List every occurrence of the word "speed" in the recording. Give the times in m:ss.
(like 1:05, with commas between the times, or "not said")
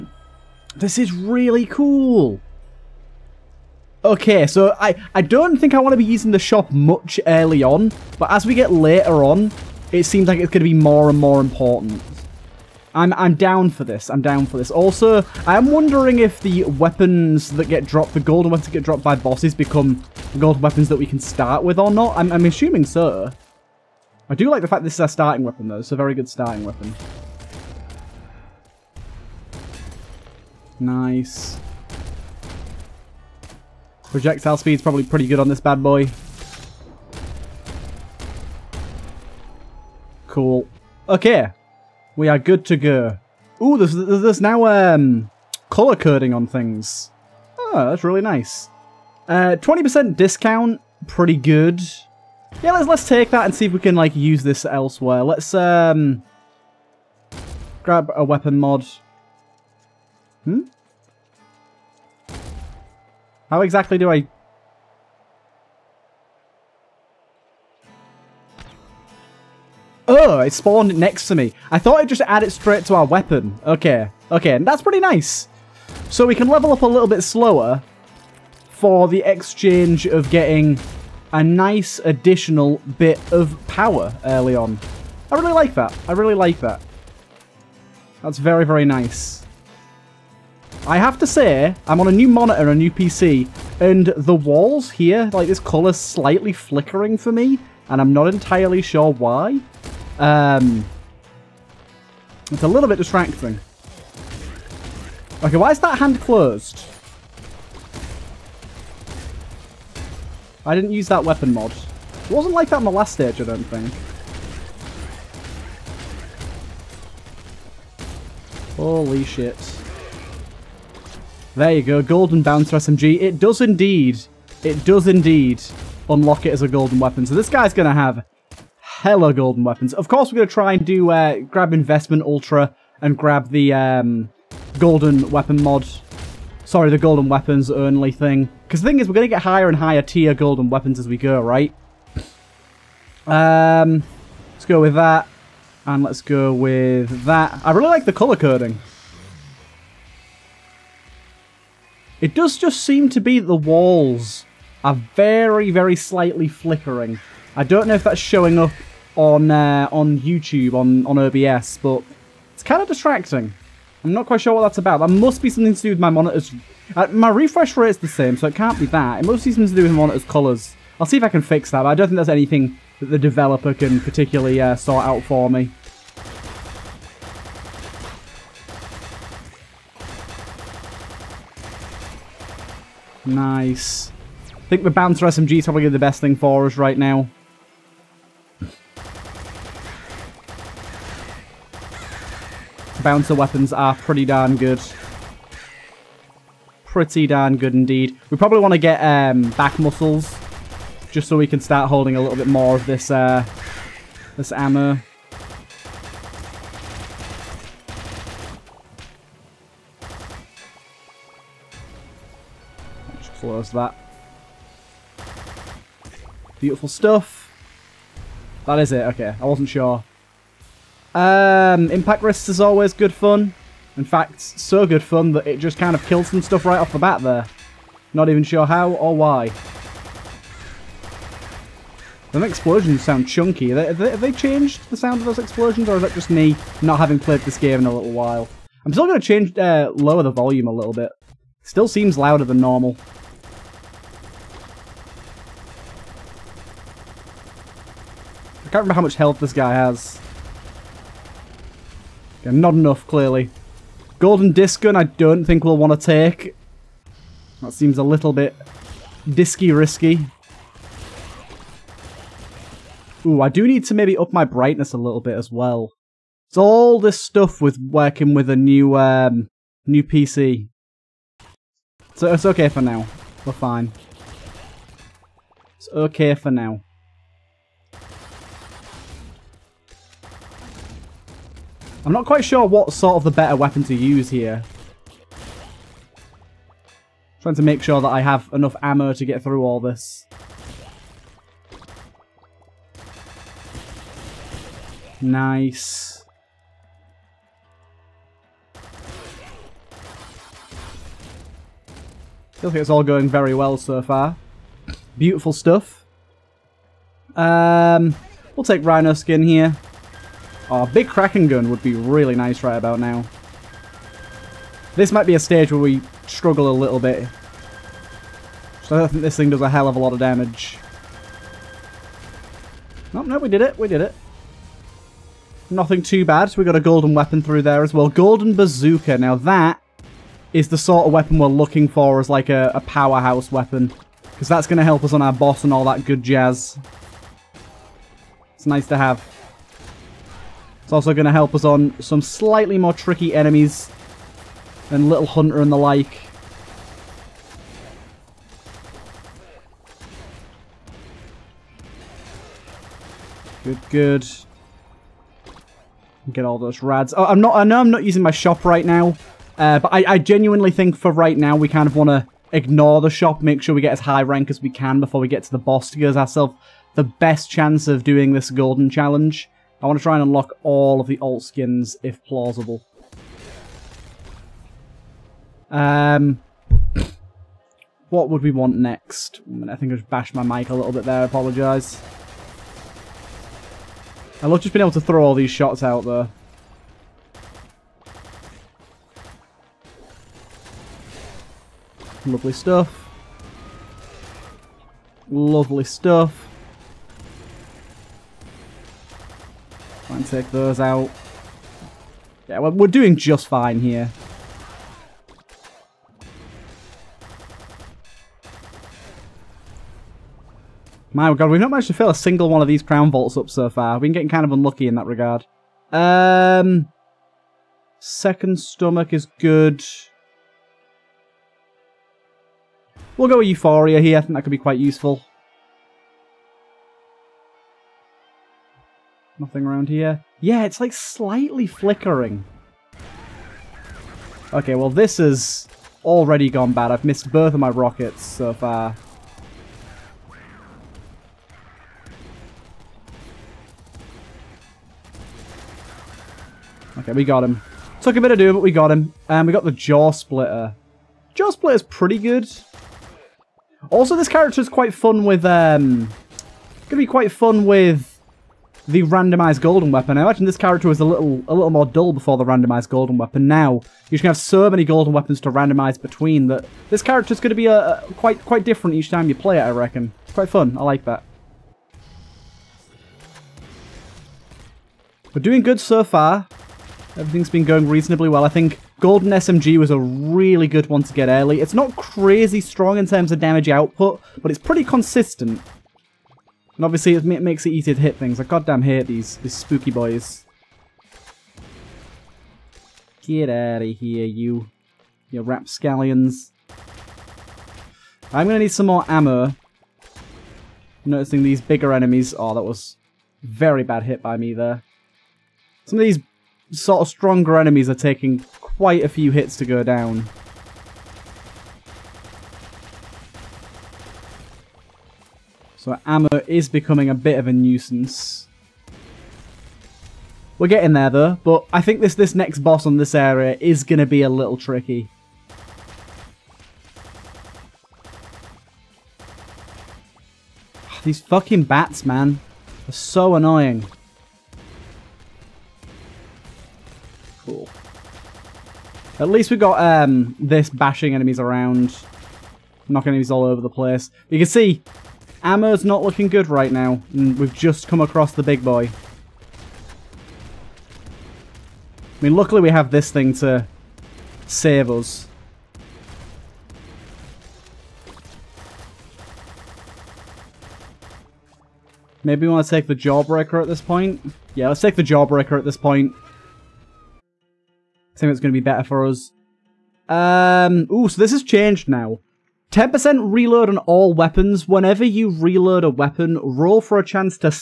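0:34.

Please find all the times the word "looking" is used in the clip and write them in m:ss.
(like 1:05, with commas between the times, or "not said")
5:31, 9:06.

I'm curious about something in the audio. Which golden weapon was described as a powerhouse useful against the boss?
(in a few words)
Golden bazooka.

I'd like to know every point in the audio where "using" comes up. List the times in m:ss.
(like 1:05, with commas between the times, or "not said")
0:06, 5:58.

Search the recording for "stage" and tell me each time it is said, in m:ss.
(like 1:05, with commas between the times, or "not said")
1:53, 5:15.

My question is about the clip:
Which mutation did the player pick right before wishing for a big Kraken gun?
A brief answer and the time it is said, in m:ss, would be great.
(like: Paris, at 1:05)
Rhino Skin, at 5:08.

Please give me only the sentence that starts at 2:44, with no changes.
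That must be something to do with my monitor's...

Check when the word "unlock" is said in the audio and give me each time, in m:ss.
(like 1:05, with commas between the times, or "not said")
2:06, 6:10.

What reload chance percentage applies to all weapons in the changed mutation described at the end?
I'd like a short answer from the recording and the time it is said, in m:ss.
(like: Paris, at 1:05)
10%, at 9:32.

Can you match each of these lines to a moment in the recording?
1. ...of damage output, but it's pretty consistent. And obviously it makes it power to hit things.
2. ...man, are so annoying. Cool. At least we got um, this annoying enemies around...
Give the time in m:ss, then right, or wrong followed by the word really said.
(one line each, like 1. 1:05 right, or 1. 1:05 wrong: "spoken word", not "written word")
1. 8:03 wrong: "easier", not "power"
2. 8:52 wrong: "bashing", not "annoying".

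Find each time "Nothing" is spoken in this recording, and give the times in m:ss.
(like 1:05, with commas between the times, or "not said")
5:25, 7:09.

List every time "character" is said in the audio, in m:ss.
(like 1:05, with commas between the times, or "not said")
7:34, 7:40, 7:47.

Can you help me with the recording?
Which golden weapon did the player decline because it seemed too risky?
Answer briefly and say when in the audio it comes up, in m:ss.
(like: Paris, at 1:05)
Golden disc gun, at 4:14.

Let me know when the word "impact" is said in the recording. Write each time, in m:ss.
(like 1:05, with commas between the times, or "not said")
3:41.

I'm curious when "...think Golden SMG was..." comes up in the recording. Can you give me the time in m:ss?
7:58.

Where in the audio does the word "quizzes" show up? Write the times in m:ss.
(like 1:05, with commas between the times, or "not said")
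not said.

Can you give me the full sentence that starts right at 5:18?
So I don't think this thing does a hell of a lot of damage.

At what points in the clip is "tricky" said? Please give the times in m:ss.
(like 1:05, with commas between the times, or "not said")
5:42, 8:44.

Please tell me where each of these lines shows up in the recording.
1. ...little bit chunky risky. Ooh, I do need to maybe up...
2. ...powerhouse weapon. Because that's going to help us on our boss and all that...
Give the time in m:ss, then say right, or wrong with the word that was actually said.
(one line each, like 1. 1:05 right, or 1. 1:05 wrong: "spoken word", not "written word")
1. 4:18 wrong: "disky", not "chunky"
2. 5:32 right.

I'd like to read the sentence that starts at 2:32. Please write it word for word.
It does just seem to be the walls are very, very slightly flickering.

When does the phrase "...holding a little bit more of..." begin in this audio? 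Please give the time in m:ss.
3:21.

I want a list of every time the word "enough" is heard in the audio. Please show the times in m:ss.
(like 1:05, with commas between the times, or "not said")
4:12, 4:48.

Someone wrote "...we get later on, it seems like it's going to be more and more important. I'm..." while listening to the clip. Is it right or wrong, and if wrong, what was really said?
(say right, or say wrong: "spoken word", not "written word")
right.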